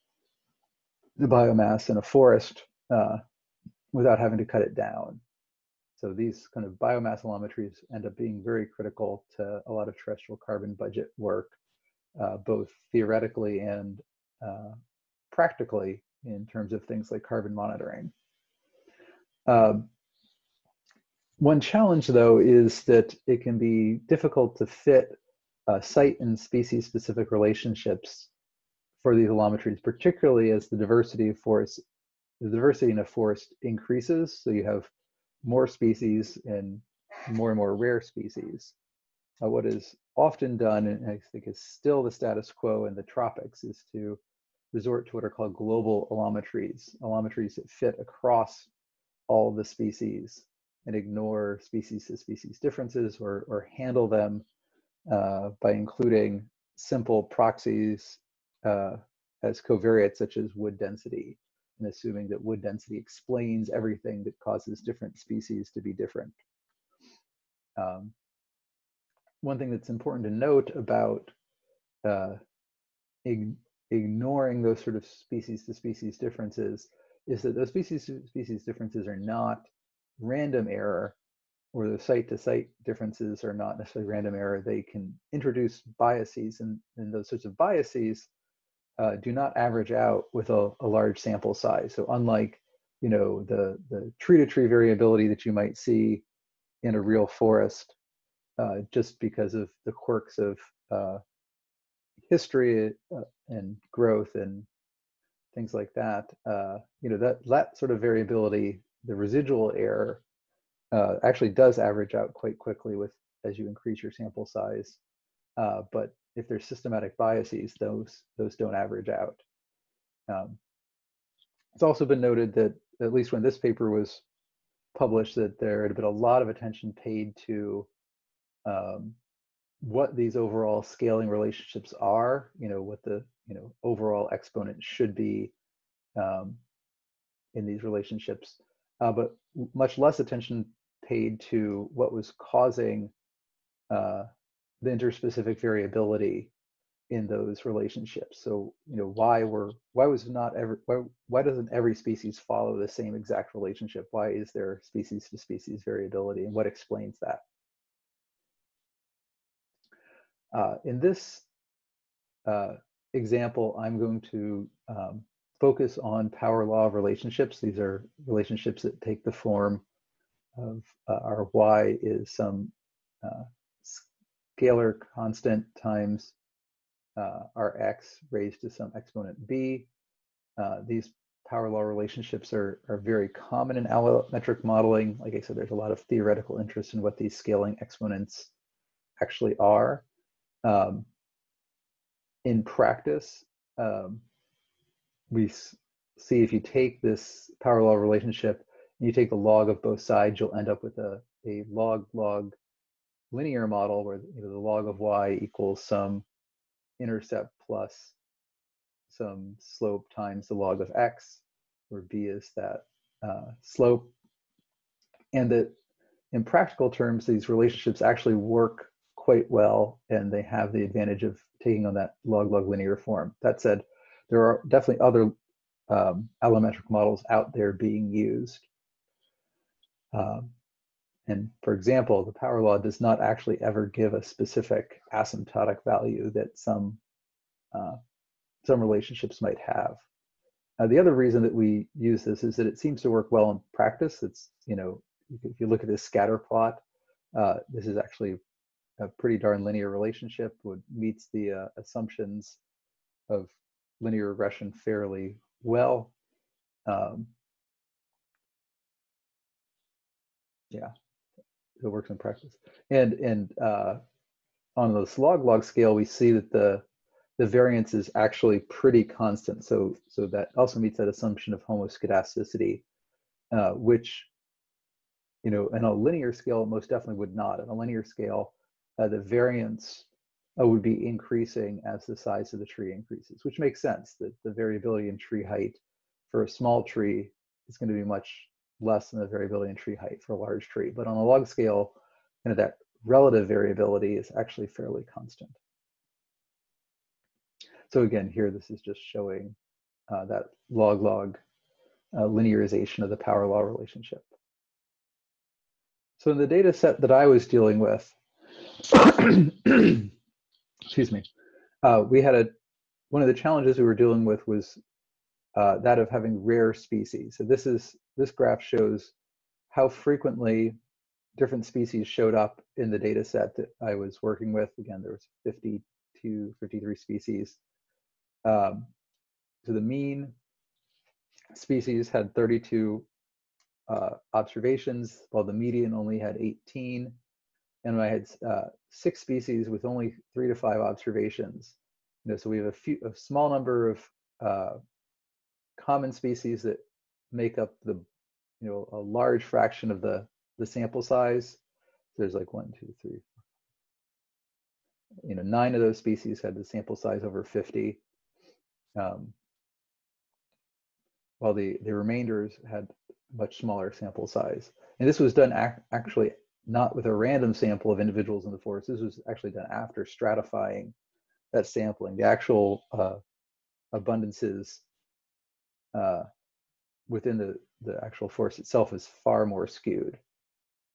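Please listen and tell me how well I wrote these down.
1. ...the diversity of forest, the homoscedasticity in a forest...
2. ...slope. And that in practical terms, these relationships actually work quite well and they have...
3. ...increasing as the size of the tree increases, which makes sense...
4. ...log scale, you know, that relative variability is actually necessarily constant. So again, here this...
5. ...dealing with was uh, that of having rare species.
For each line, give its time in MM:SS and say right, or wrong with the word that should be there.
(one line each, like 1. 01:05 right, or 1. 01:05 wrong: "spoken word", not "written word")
1. 00:30 wrong: "diversity", not "homoscedasticity"
2. 03:33 right
3. 04:41 right
4. 04:51 wrong: "fairly", not "necessarily"
5. 05:13 right.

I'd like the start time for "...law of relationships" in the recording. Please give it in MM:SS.
02:46.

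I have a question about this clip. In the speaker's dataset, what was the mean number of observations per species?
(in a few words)
32.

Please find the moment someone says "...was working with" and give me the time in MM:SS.
05:23.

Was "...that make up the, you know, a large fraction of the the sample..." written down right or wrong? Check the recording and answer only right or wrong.
right.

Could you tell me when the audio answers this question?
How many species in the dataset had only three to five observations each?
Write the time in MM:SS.
05:38.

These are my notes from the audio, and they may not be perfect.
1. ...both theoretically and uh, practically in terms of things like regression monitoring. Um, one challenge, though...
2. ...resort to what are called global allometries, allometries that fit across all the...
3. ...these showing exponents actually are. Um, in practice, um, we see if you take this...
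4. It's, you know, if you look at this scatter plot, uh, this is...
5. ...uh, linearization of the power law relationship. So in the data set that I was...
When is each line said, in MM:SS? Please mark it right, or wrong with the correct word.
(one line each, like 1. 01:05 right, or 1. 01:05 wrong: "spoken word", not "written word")
1. 00:12 wrong: "carbon", not "regression"
2. 00:44 right
3. 03:07 wrong: "scaling", not "showing"
4. 04:04 right
5. 05:02 right.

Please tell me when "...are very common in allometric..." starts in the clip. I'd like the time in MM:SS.
03:02.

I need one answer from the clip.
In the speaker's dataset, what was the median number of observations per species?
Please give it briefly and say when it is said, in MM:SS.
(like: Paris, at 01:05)
18, at 05:36.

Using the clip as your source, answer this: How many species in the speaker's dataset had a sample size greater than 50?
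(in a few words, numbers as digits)
9.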